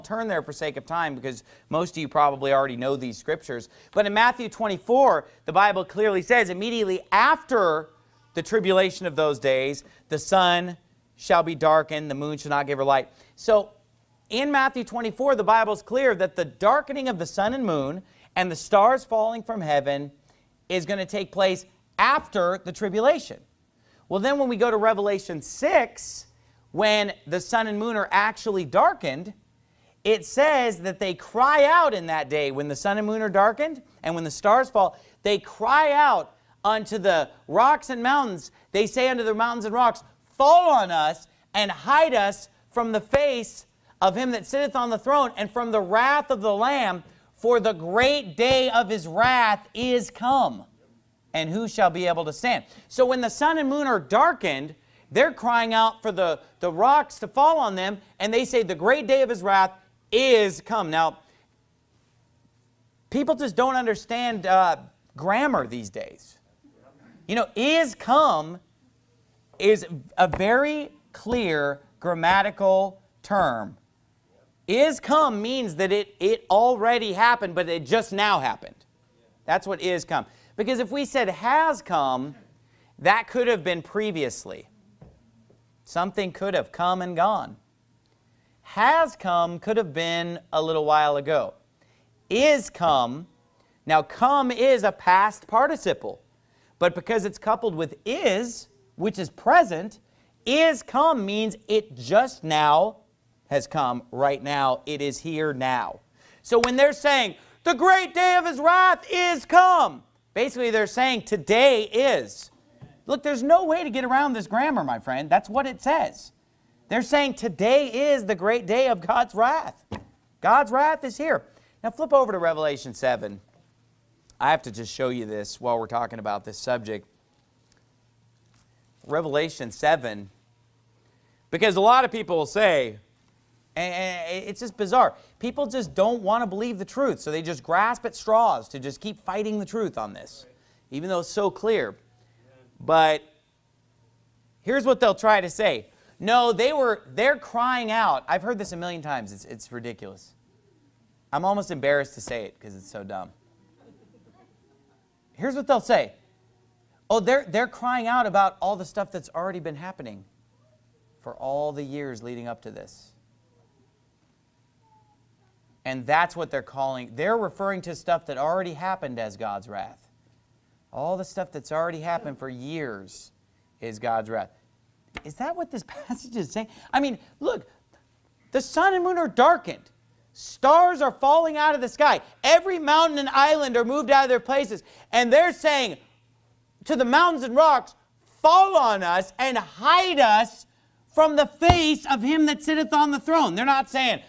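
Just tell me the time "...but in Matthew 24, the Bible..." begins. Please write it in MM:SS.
00:03.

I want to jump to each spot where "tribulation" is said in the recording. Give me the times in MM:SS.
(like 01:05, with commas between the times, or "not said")
00:08, 00:22.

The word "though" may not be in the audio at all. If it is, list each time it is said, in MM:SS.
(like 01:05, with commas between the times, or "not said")
02:21.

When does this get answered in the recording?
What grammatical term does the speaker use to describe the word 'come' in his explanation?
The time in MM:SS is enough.
01:34.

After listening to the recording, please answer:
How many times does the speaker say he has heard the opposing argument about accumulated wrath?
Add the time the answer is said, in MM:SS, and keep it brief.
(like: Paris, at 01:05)
a million, at 02:28.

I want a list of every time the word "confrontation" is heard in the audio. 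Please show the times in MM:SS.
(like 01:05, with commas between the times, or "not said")
not said.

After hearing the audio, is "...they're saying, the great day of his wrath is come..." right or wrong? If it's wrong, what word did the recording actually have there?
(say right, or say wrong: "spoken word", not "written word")
right.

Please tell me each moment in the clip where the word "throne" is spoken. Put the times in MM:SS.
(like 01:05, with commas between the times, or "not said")
00:44, 03:13.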